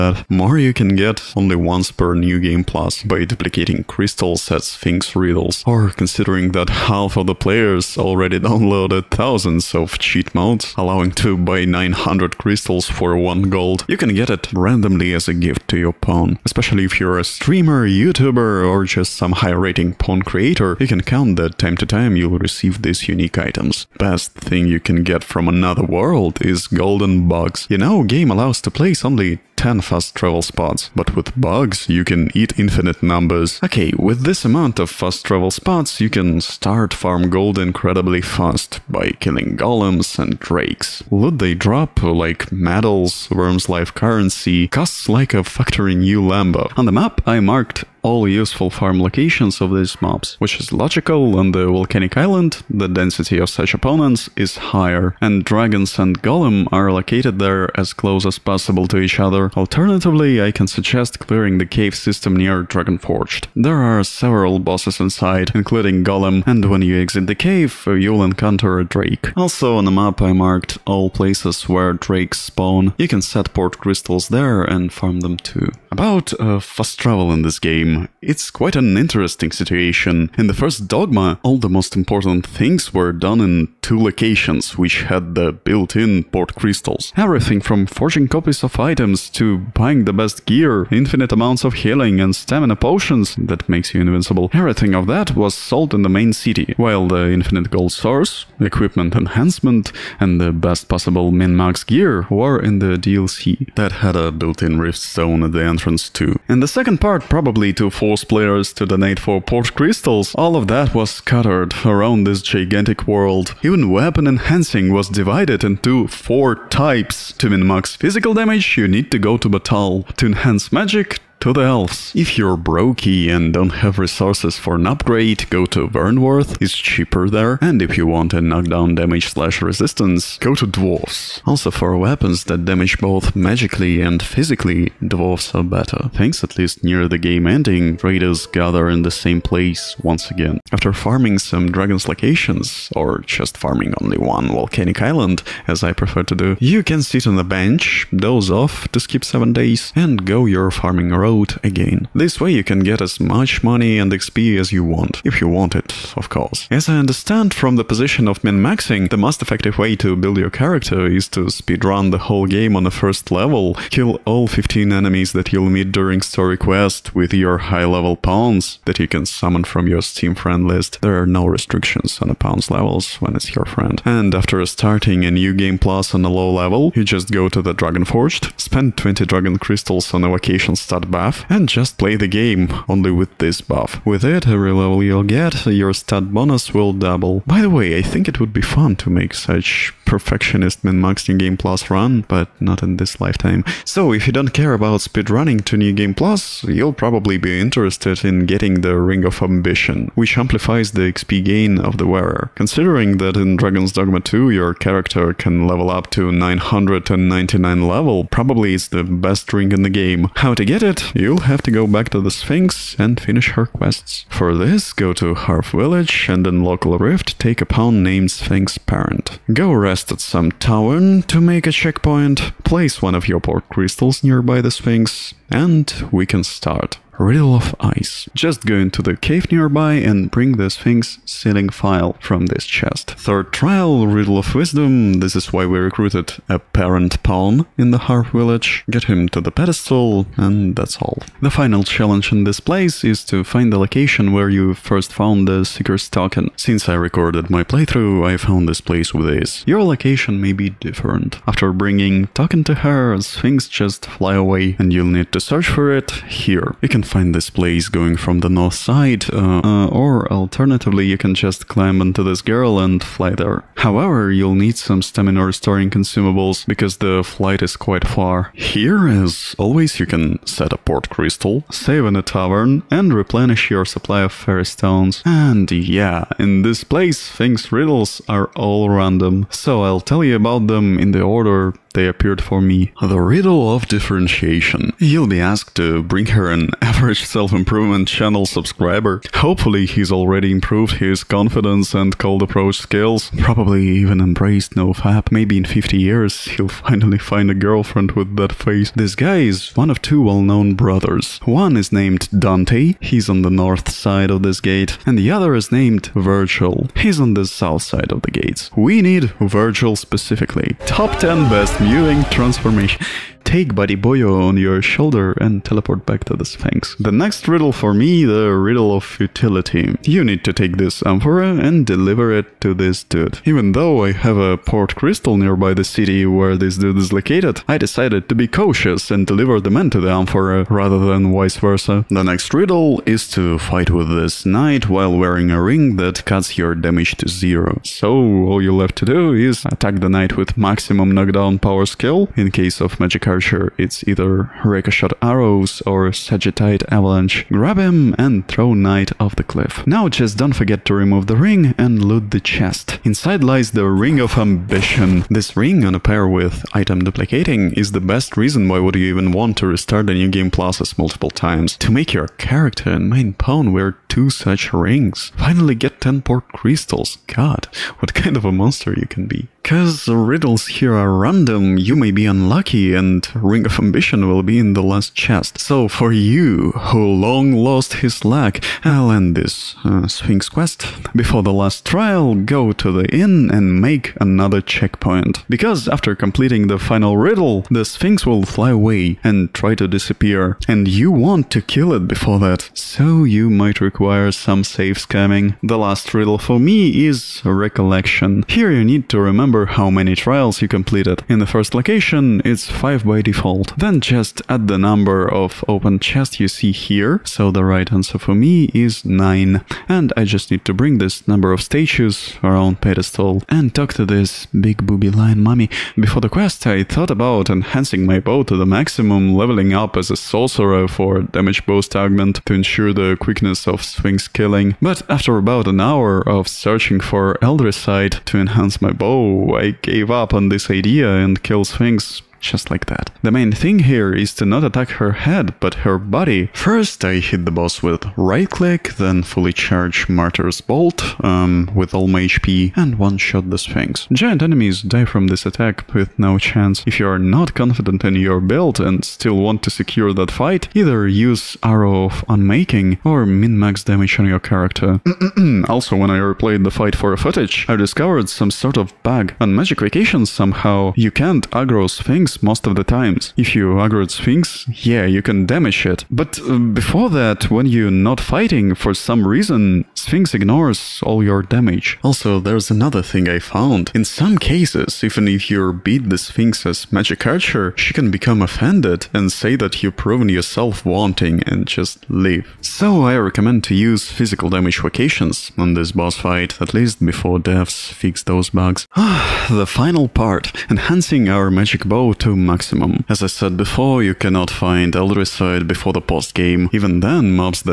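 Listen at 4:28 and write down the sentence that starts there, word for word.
Here, as always, you can set a port crystal, save in a tavern, and replenish your supply of fairy stones.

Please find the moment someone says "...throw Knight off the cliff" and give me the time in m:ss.
5:48.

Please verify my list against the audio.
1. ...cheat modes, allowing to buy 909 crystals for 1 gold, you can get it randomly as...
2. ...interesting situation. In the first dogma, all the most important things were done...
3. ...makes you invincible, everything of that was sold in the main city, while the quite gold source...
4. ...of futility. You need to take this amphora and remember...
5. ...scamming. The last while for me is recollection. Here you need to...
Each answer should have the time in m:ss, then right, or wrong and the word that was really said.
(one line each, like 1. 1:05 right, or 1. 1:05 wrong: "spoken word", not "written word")
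1. 0:09 wrong: "900", not "909"
2. 1:18 right
3. 1:33 wrong: "infinite", not "quite"
4. 5:18 wrong: "deliver", not "remember"
5. 6:35 wrong: "riddle", not "while".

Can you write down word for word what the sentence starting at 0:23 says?
Best thing you can get from another world is golden bugs.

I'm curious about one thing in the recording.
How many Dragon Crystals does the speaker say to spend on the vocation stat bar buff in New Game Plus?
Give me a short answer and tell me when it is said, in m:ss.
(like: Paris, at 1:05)
20, at 2:58.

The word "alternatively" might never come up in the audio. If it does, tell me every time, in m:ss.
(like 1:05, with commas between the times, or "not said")
0:59, 4:20.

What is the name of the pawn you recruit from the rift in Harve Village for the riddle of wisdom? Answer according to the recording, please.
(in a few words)
Sphinx Parent.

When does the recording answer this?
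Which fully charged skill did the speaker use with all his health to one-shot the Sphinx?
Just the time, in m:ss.
7:20.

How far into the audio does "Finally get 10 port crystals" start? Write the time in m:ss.
6:05.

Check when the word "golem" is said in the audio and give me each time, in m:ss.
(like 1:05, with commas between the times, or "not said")
0:39, 0:56, 1:06.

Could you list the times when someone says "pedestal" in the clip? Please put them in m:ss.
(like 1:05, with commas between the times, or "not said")
3:59, 6:52.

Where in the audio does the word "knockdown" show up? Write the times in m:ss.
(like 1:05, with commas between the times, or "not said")
2:08, 5:41.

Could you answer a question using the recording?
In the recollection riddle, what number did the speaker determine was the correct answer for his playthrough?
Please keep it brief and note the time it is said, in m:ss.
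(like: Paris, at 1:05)
9, at 6:49.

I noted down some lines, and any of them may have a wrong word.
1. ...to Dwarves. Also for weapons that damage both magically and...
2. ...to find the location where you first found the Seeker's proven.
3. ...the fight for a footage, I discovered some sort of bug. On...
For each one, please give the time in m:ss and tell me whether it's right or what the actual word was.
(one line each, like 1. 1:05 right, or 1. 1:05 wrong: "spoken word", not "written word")
1. 2:10 right
2. 4:03 wrong: "token", not "proven"
3. 7:36 right.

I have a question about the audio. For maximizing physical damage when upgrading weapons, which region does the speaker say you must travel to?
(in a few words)
Battahl.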